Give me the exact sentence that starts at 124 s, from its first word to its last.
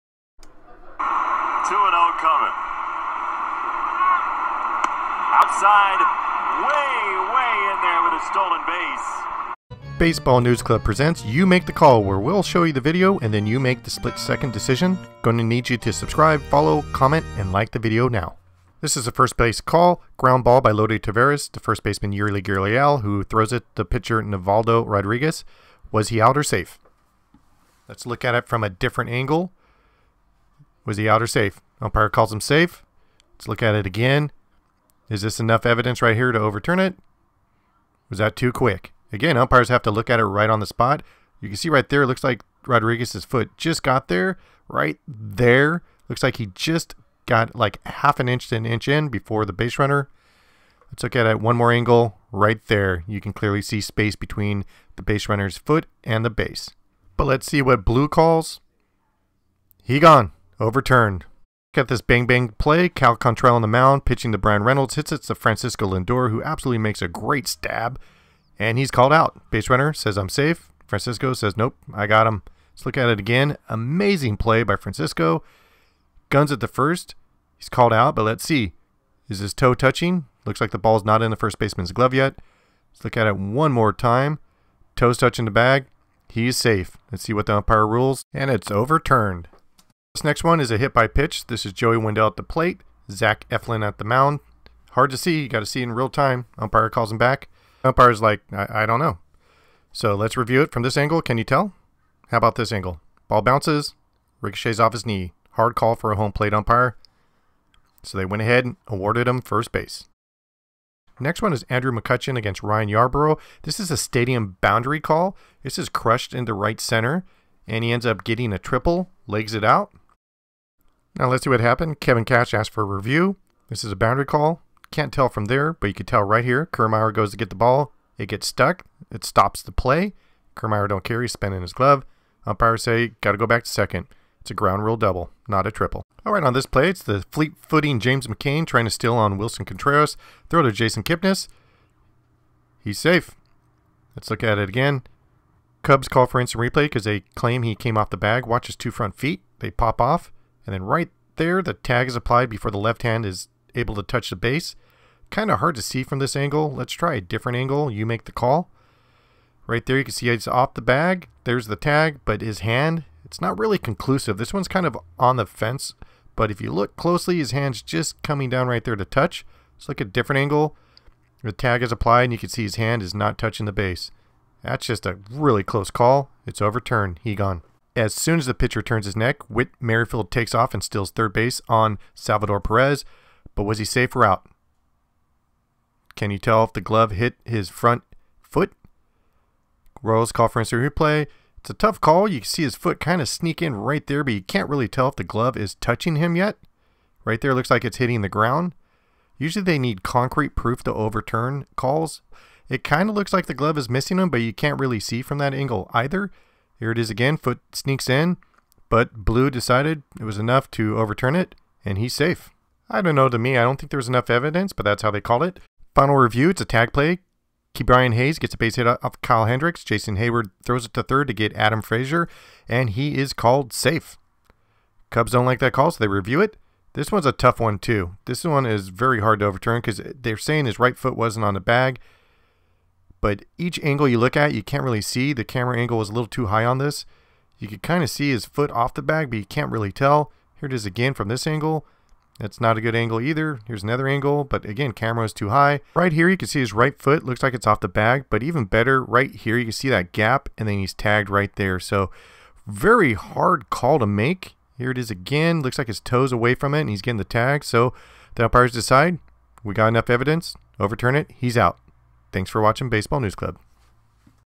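Can't tell from there, but you can tell right here.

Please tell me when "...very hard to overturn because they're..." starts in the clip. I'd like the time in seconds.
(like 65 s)
228 s.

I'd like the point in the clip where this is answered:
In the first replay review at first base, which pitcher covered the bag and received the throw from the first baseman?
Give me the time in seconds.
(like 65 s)
24 s.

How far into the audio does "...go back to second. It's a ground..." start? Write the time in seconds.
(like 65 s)
133 s.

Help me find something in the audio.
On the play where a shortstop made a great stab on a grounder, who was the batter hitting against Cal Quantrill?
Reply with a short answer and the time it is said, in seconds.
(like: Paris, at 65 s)
Bryan Reynolds, at 64 s.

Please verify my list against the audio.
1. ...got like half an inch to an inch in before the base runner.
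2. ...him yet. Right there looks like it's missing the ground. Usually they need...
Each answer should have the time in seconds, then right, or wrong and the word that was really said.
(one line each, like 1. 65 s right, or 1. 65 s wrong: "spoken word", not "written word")
1. 47 s right
2. 196 s wrong: "hitting", not "missing".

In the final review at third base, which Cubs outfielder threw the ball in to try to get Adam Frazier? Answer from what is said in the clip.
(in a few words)
Jason Heyward.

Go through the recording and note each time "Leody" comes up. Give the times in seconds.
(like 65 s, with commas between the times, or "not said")
20 s.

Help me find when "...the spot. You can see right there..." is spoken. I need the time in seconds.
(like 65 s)
40 s.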